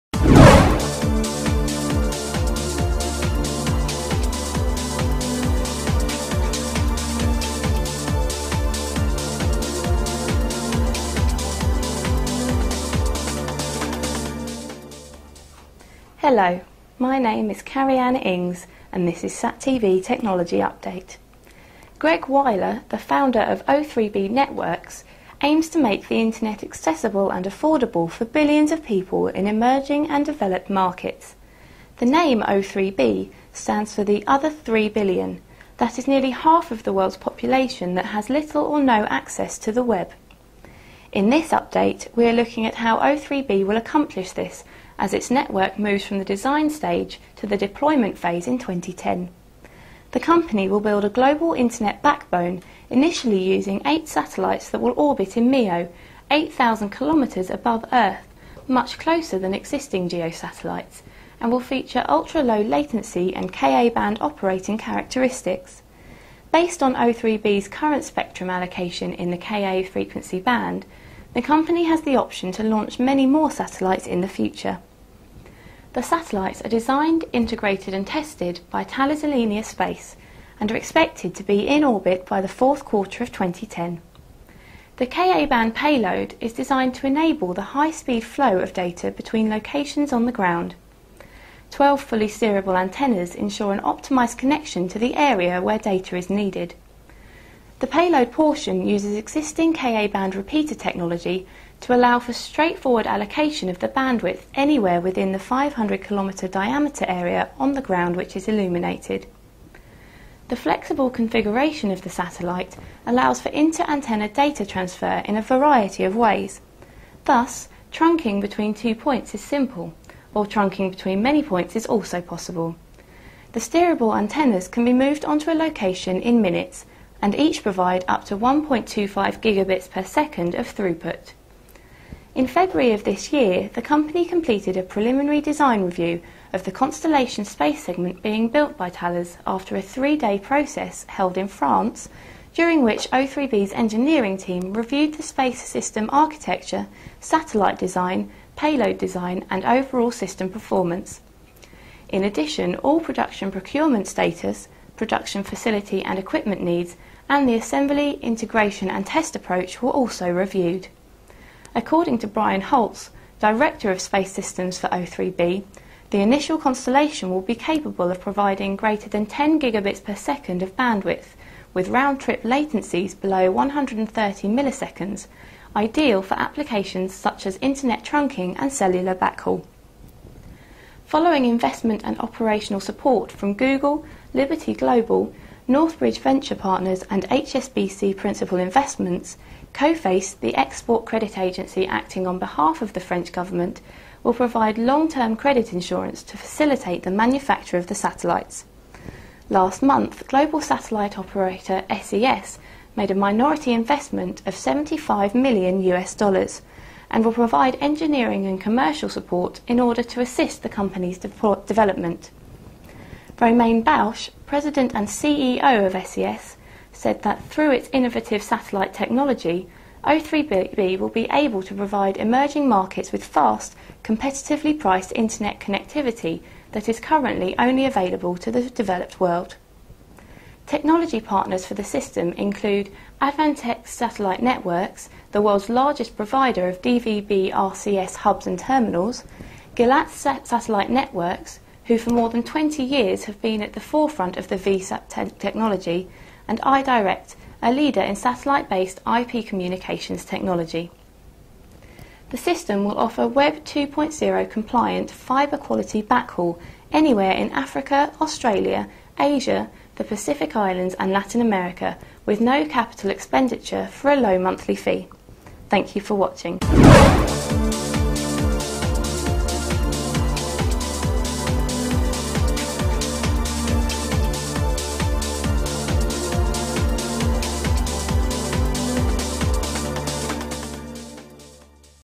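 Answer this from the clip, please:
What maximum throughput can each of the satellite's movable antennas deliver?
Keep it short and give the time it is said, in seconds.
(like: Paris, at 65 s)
1.25 gigabits per second, at 128 s.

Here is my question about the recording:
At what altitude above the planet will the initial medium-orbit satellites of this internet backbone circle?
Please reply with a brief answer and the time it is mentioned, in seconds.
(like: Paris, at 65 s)
8,000 kilometres, at 56 s.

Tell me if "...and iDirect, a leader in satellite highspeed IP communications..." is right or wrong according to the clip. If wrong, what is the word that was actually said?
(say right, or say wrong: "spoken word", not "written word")
wrong: "based", not "highspeed".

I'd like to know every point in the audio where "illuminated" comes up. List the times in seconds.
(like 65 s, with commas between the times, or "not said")
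108 s.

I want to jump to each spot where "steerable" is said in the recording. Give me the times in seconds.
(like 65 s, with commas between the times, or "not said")
92 s, 123 s.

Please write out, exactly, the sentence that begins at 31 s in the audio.
The name O3B stands for the other 3 billion.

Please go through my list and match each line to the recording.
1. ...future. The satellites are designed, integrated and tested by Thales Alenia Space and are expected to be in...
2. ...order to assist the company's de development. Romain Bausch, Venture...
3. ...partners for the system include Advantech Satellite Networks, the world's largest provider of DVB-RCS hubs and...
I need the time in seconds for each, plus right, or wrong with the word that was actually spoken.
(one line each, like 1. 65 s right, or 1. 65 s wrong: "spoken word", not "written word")
1. 74 s right
2. 209 s wrong: "President", not "Venture"
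3. 231 s right.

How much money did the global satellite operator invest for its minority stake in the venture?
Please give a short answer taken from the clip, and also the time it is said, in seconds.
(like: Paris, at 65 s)
$75 million, at 204 s.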